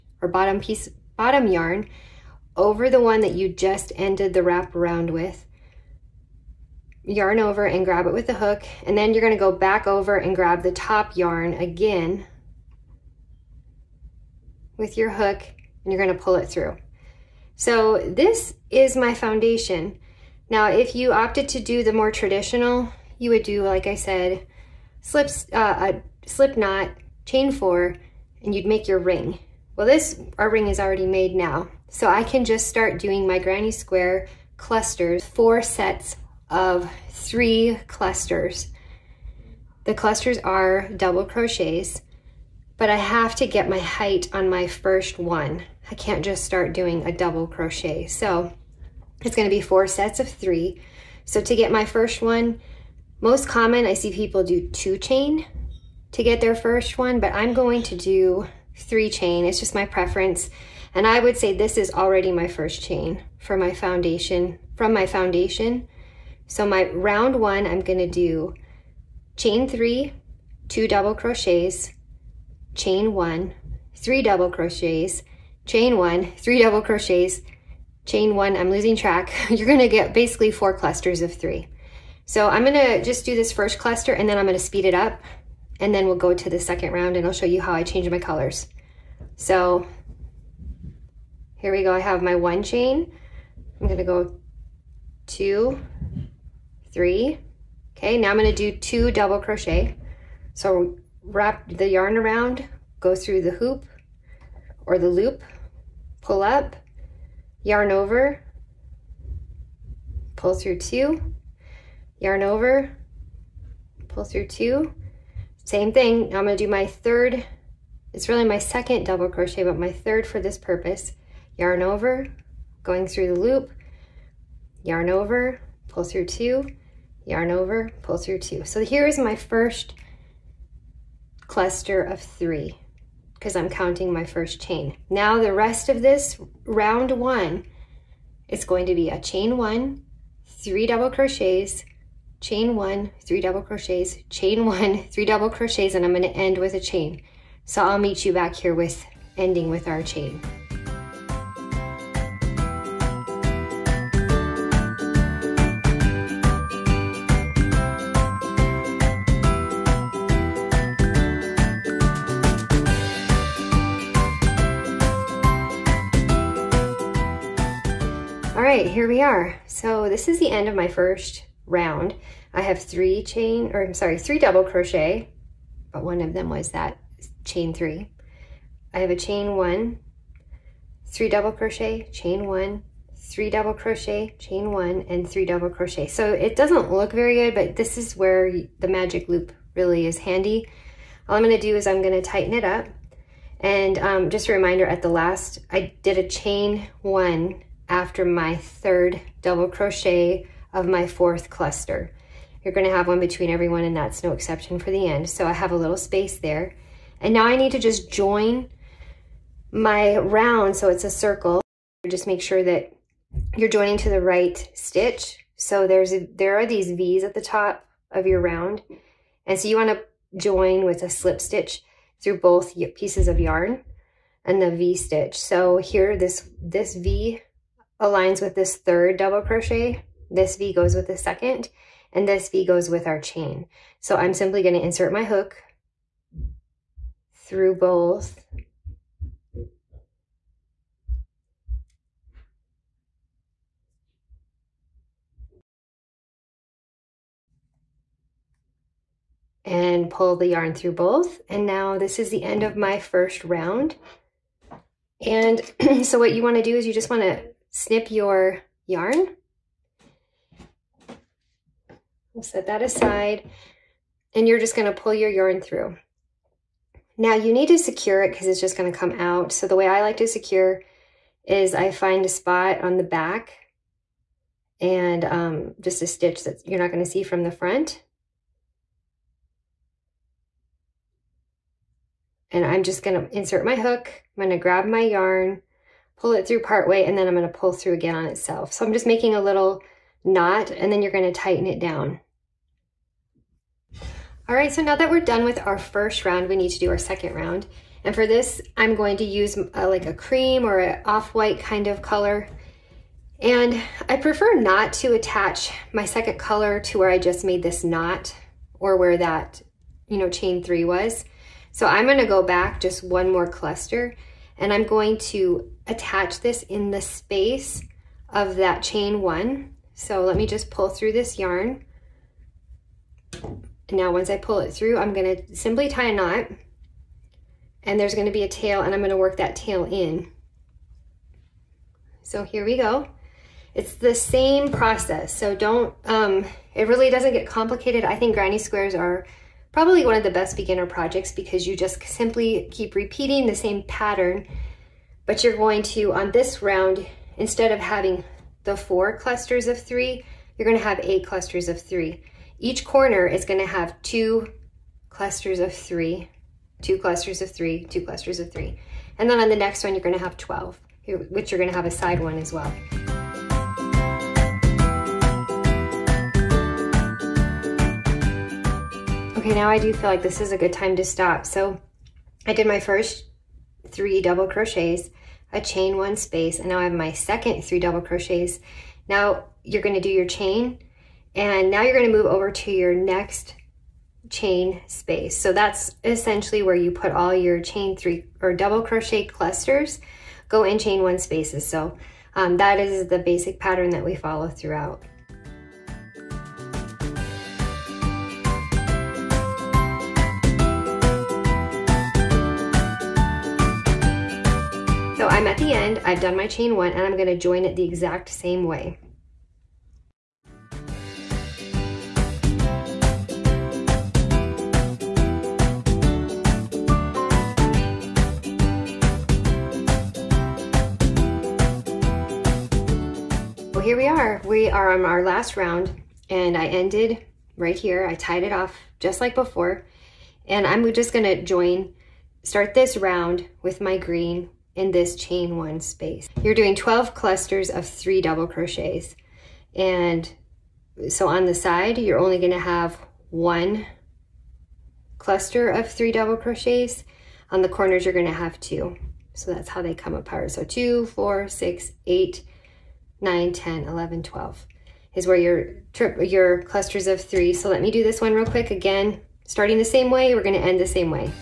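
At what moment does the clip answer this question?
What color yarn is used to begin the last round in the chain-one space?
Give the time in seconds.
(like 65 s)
433 s.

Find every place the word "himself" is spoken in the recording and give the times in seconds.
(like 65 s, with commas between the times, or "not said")
not said.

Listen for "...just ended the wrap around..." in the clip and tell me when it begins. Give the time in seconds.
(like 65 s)
3 s.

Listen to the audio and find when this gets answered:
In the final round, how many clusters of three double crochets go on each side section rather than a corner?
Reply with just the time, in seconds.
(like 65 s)
442 s.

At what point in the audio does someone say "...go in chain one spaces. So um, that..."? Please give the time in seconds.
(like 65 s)
390 s.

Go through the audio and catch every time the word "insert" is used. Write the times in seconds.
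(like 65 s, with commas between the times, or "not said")
234 s, 283 s.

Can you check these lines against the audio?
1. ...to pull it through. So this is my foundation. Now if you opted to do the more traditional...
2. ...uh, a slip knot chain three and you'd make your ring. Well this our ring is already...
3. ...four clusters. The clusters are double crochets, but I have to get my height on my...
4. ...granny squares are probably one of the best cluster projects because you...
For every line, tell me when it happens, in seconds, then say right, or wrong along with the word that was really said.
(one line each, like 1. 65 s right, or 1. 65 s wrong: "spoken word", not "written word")
1. 16 s right
2. 25 s wrong: "four", not "three"
3. 37 s wrong: "three", not "four"
4. 338 s wrong: "beginner", not "cluster".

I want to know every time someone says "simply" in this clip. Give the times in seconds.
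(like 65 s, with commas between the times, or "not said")
234 s, 325 s, 342 s.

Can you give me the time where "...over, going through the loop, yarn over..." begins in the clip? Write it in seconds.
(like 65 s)
121 s.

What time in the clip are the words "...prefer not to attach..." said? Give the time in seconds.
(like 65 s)
304 s.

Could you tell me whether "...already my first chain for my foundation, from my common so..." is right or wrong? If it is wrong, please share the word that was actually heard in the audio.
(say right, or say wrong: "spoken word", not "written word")
wrong: "foundation", not "common".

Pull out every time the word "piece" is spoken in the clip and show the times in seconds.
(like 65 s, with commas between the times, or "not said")
0 s, 222 s.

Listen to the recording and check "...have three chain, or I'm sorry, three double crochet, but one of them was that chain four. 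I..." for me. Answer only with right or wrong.
wrong.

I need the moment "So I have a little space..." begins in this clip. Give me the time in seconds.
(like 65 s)
205 s.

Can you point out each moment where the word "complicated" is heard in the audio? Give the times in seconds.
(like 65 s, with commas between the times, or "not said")
337 s.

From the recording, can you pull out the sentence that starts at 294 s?
All right, so now that we're done with our first round, we need to do our second round.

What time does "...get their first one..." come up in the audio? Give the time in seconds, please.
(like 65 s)
56 s.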